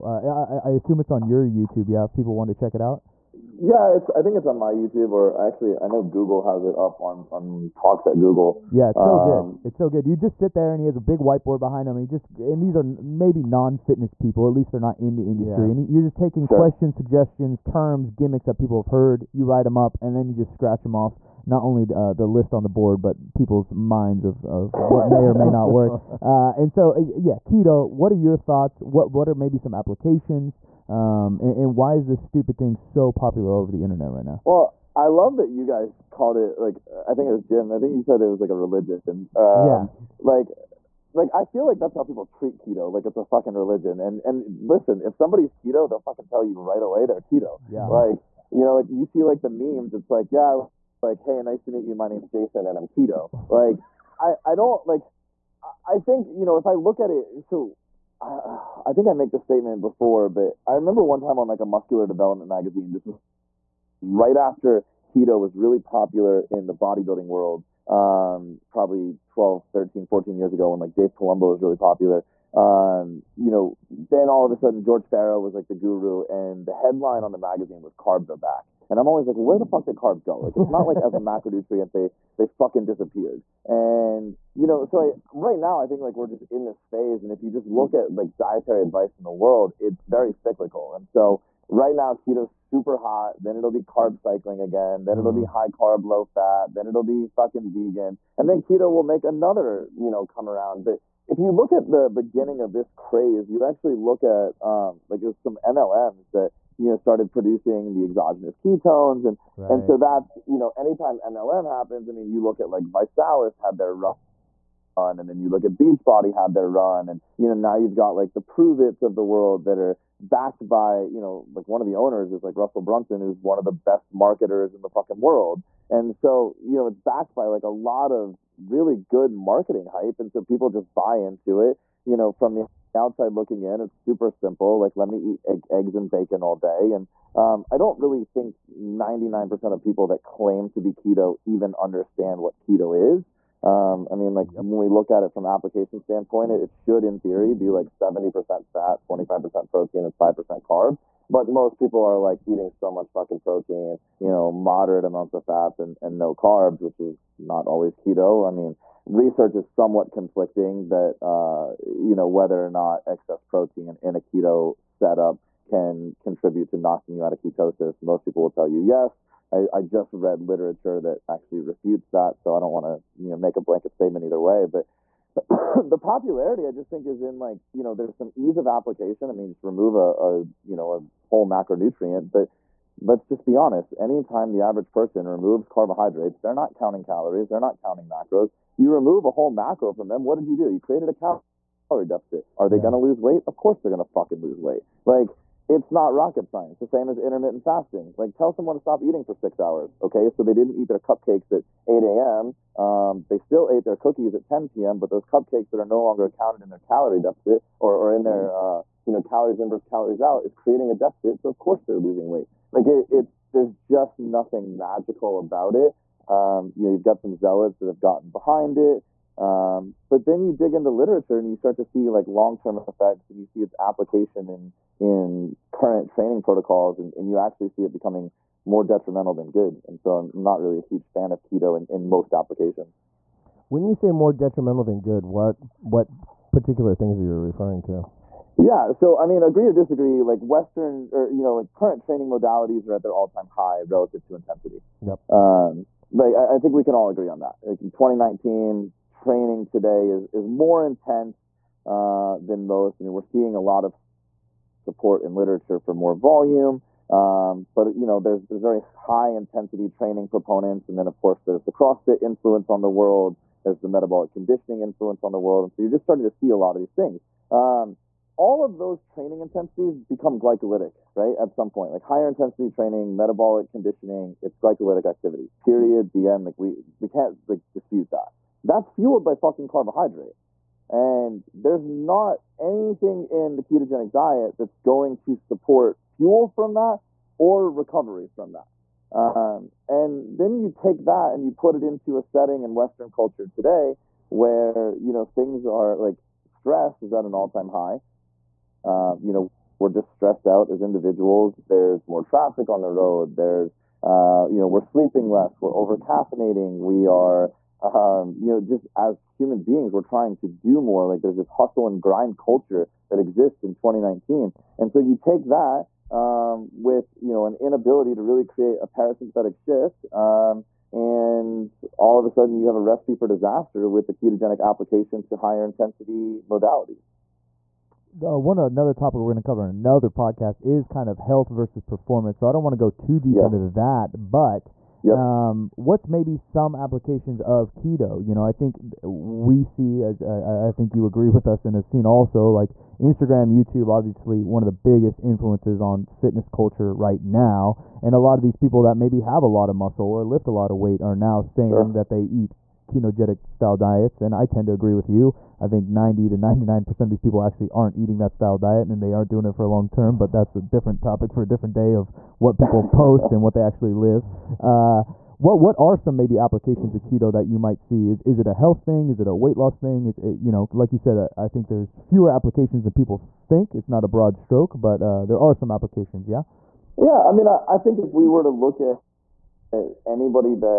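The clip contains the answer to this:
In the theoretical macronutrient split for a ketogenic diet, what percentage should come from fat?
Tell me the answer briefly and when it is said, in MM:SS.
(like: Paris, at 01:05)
70%, at 02:27.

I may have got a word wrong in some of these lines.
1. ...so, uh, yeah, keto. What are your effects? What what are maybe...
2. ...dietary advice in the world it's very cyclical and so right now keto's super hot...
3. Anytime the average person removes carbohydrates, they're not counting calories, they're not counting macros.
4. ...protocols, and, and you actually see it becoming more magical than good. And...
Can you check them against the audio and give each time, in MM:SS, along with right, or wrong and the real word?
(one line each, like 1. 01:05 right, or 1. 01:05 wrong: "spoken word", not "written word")
1. 00:26 wrong: "thoughts", not "effects"
2. 01:28 right
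3. 03:03 right
4. 03:46 wrong: "detrimental", not "magical".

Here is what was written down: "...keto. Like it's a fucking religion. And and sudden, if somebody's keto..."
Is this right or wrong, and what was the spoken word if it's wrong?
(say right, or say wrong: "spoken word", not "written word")
wrong: "listen", not "sudden".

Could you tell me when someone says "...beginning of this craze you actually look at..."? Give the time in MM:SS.
01:42.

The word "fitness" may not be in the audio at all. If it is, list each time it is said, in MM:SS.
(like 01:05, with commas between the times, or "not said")
00:13, 05:46.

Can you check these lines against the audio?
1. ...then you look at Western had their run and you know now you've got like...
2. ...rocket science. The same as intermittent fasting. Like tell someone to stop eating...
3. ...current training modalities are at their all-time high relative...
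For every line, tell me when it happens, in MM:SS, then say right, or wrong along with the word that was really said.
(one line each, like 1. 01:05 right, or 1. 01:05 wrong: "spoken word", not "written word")
1. 01:55 wrong: "Beachbody", not "Western"
2. 03:16 right
3. 04:01 right.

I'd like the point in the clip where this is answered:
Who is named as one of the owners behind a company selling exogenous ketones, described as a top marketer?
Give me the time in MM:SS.
02:02.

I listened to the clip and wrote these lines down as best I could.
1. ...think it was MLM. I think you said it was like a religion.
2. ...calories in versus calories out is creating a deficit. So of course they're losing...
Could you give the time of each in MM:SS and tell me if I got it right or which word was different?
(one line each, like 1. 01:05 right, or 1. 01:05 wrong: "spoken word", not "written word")
1. 00:37 wrong: "Jim", not "MLM"
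2. 03:29 right.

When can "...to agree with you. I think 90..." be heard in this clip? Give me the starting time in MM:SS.
05:54.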